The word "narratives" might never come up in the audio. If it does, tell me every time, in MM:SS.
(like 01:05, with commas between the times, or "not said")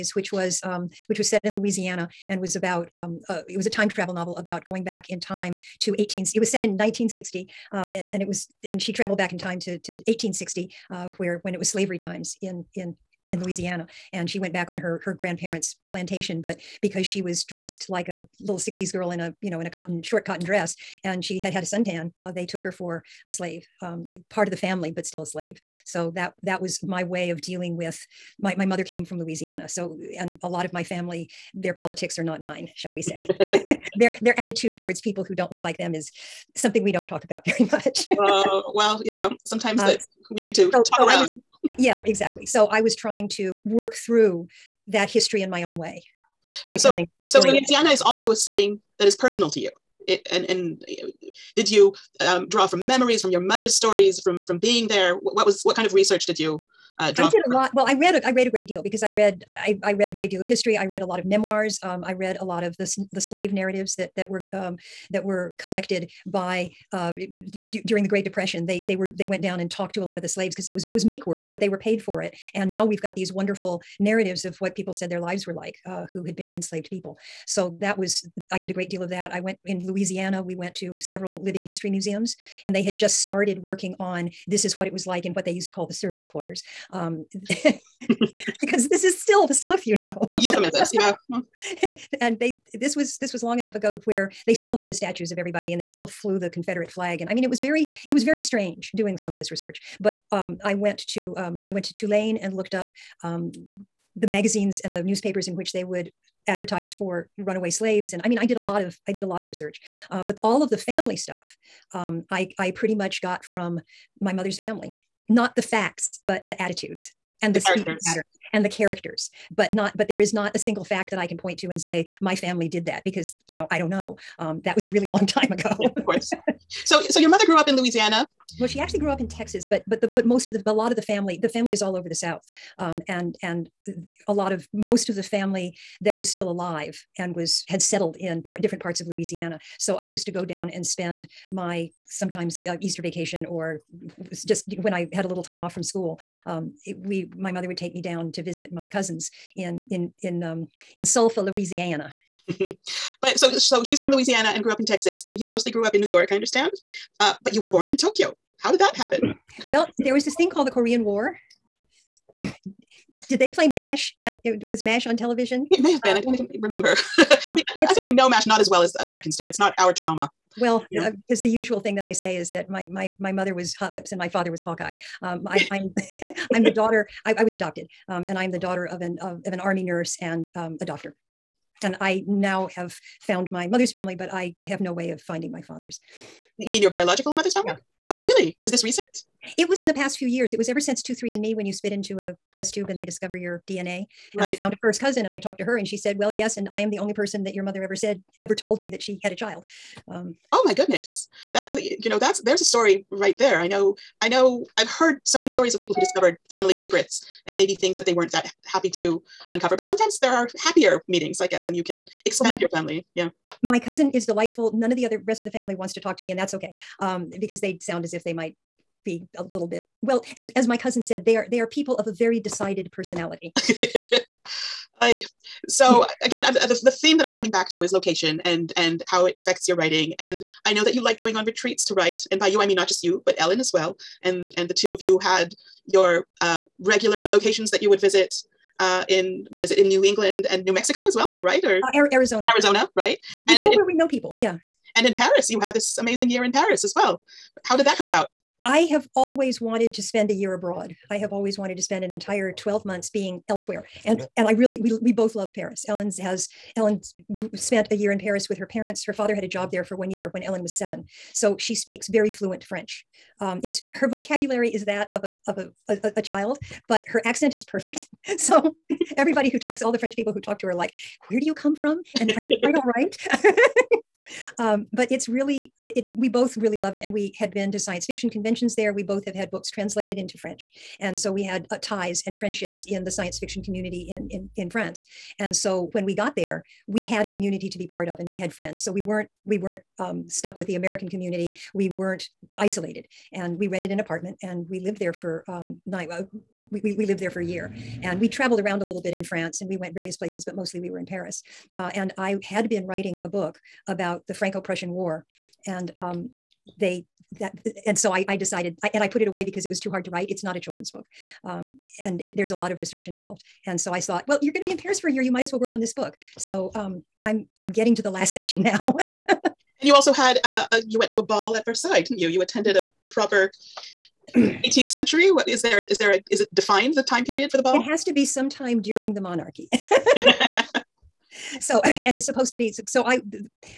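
01:03, 01:13.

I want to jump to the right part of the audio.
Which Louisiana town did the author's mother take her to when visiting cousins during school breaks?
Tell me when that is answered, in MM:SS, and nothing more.
02:31.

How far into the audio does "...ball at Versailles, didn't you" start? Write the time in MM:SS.
05:21.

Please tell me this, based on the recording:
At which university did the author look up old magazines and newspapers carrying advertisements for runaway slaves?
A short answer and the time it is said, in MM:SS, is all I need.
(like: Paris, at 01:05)
Tulane, at 01:41.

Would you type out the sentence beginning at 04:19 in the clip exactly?
Her father had a job there for one year when Ellen was 7.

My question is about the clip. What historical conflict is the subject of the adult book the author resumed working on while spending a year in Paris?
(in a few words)
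Franco-Prussian War.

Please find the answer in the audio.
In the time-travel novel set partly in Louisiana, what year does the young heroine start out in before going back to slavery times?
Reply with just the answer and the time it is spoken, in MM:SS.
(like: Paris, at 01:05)
1960, at 00:06.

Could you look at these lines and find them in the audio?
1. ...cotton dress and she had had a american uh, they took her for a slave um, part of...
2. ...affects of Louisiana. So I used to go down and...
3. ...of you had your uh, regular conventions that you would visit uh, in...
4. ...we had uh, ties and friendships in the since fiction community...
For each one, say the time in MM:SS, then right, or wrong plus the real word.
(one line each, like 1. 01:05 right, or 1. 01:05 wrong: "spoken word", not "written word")
1. 00:20 wrong: "suntan", not "american"
2. 02:18 wrong: "parts", not "affects"
3. 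03:54 wrong: "locations", not "conventions"
4. 04:41 wrong: "science", not "since".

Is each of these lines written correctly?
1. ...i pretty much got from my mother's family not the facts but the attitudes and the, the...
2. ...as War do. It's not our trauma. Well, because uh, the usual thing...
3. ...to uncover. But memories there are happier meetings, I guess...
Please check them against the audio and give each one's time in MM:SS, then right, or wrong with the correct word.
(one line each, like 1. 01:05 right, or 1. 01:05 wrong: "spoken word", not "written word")
1. 01:52 right
2. 02:48 wrong: "Americans", not "War"
3. 03:28 wrong: "sometimes", not "memories".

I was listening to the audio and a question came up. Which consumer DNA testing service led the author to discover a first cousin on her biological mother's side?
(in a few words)
23andMe.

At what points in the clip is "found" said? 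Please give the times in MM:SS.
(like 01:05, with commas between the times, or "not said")
03:03, 03:14.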